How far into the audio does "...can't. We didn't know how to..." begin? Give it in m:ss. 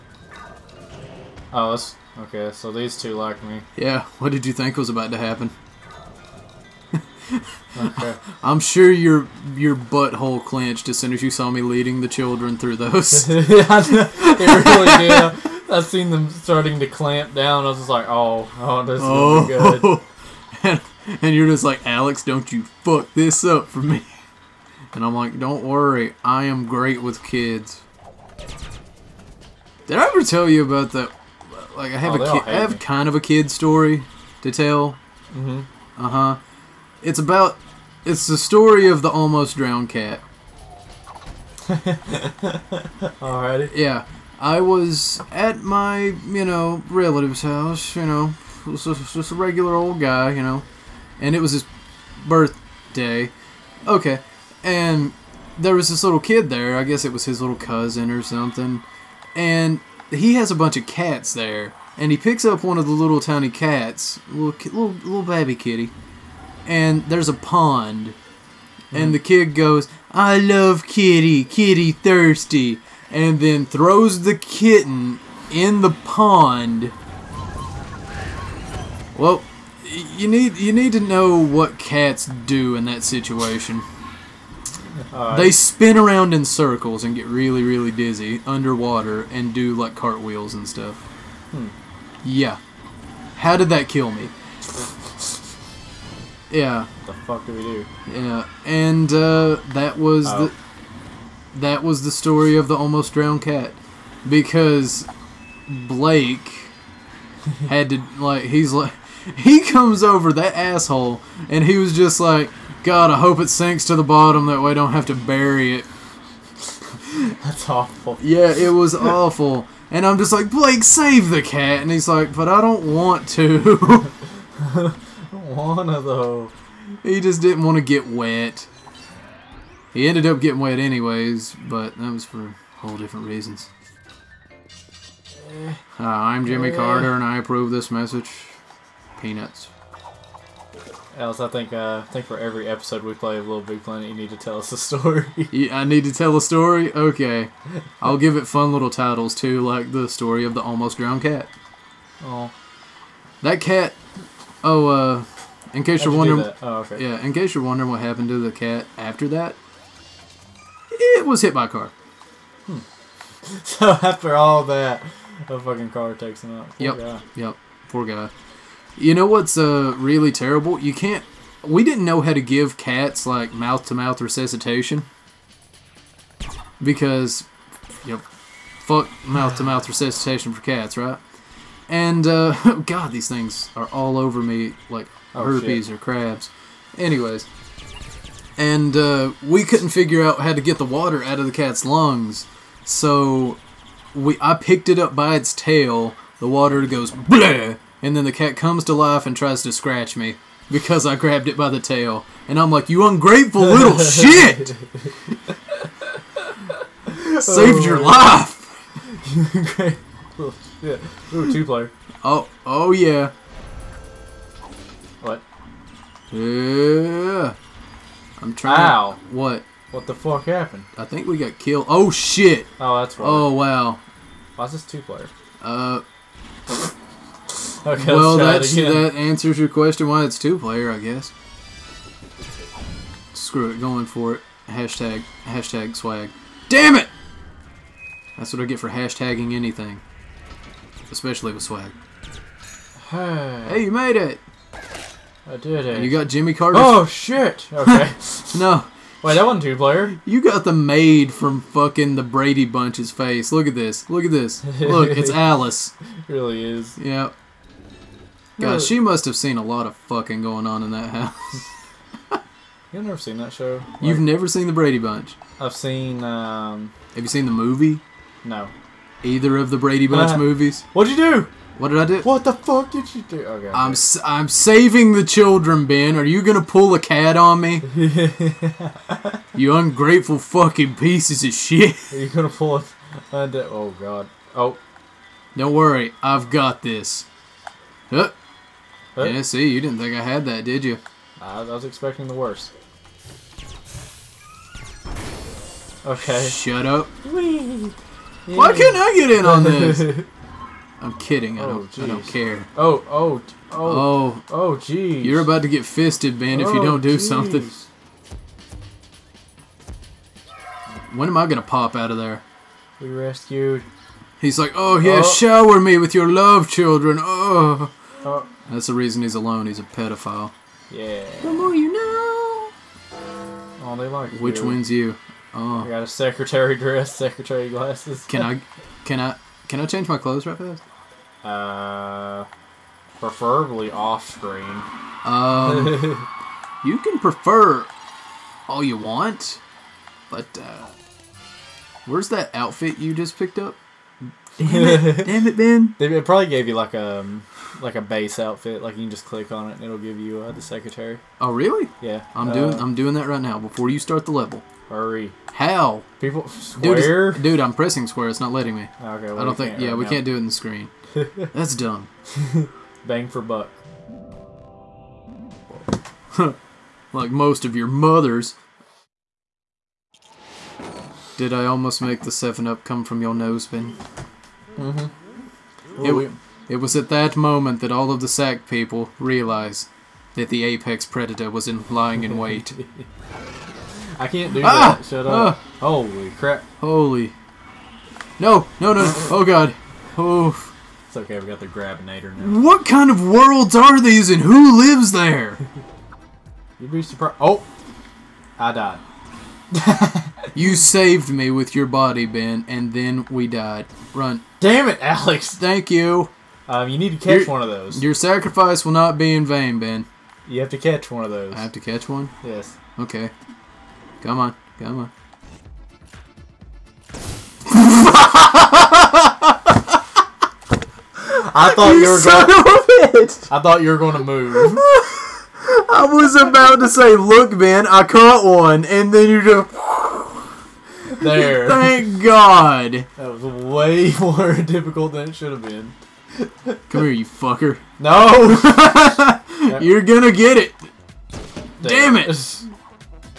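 2:50.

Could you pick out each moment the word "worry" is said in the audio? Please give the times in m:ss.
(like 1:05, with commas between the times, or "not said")
0:25, 4:45.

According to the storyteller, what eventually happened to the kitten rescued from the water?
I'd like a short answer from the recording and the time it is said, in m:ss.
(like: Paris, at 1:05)
Hit by a car, at 2:41.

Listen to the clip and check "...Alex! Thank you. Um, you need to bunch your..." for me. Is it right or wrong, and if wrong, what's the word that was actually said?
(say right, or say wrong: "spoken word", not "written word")
wrong: "catch", not "bunch".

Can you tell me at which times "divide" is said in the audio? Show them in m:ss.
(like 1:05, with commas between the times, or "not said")
not said.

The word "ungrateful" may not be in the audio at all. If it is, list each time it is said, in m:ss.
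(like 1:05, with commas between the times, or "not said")
3:23, 3:29, 4:39.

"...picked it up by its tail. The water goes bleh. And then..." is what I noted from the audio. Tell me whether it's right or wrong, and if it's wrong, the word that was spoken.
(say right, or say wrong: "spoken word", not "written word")
right.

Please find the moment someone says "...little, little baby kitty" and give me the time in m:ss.
1:04.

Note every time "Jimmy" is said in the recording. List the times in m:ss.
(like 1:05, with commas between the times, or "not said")
2:16, 4:06.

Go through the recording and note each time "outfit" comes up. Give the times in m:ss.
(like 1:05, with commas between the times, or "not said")
5:42, 5:48.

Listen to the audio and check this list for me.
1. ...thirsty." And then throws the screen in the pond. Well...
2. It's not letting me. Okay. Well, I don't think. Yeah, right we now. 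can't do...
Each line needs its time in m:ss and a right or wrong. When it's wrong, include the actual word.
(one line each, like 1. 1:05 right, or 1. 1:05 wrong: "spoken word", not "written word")
1. 1:11 wrong: "kitten", not "screen"
2. 5:58 right.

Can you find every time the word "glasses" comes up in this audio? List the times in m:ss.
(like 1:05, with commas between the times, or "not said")
5:27.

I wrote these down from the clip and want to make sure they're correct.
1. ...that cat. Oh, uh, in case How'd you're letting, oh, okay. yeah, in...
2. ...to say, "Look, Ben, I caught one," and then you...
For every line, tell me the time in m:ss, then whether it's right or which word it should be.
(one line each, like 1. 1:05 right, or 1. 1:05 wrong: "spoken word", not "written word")
1. 2:33 wrong: "wondering", not "letting"
2. 7:06 right.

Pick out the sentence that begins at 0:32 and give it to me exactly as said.
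kind of a kid story to tell.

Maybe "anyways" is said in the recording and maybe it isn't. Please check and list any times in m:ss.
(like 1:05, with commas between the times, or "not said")
2:10, 3:06.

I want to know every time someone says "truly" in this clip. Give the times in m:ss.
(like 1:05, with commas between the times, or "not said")
not said.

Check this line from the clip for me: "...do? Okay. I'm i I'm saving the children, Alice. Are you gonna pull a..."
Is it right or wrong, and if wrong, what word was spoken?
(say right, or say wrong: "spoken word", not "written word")
wrong: "Ben", not "Alice".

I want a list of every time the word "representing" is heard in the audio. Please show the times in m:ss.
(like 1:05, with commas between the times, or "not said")
not said.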